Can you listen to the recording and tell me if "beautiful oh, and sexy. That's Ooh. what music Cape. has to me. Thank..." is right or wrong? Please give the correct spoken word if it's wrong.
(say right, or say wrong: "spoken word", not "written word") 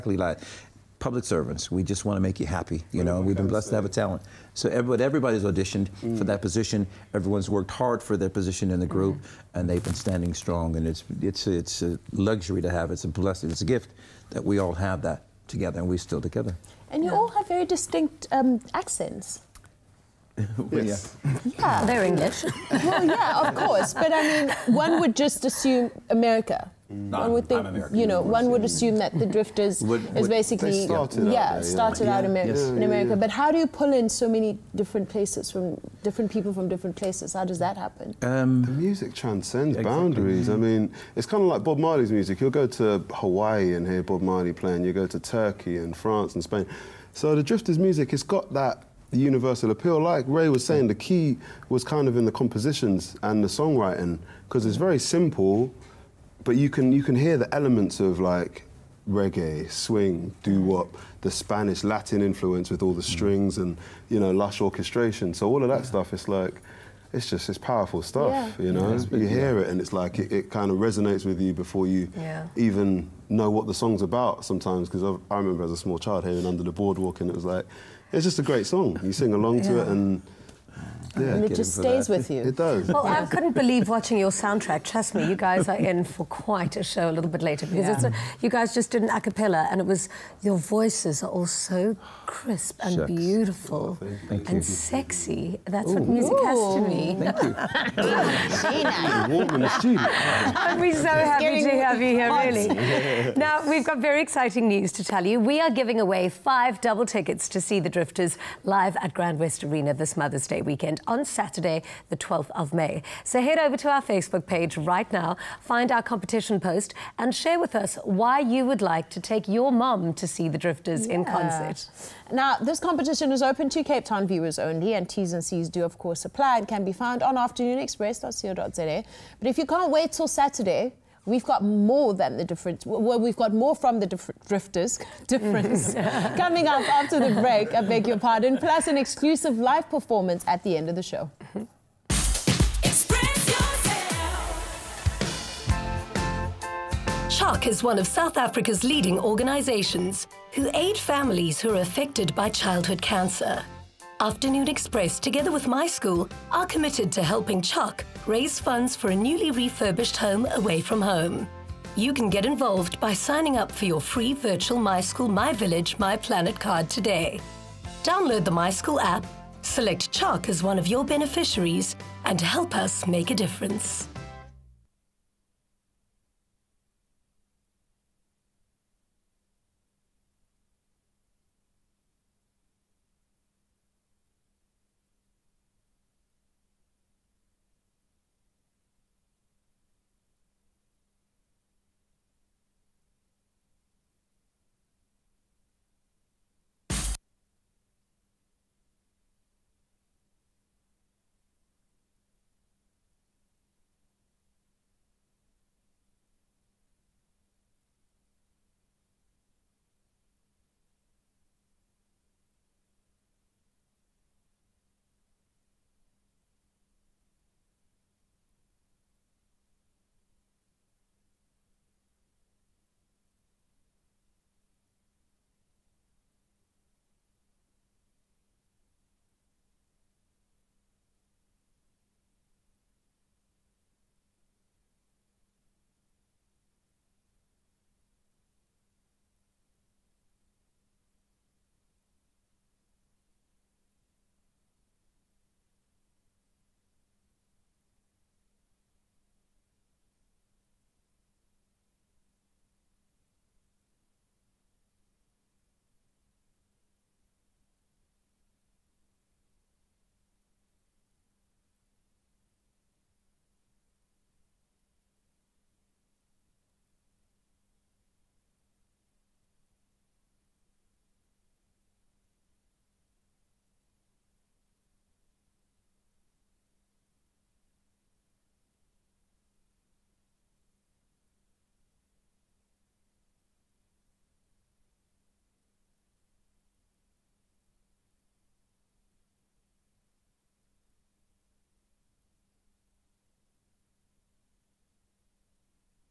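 wrong: "Ooh", not "Cape".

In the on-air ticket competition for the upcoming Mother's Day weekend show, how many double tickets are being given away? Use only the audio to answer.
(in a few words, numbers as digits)
5.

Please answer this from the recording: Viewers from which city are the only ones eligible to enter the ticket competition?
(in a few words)
Cape Town.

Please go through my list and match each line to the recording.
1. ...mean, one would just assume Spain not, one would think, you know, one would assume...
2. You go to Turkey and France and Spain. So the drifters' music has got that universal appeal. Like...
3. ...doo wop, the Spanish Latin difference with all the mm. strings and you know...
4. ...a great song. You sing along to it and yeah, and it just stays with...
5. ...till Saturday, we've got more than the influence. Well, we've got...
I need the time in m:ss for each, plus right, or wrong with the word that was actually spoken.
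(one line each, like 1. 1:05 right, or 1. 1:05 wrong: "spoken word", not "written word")
1. 0:24 wrong: "America", not "Spain"
2. 0:44 right
3. 1:00 wrong: "influence", not "difference"
4. 1:18 right
5. 2:10 wrong: "difference", not "influence".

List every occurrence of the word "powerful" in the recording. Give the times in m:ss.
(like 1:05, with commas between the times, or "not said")
1:07.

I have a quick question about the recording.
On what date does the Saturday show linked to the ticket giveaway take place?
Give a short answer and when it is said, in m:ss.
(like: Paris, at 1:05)
12 May, at 1:52.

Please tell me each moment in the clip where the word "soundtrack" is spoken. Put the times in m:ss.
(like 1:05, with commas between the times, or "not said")
1:24.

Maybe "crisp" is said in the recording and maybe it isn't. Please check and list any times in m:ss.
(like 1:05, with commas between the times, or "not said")
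1:32.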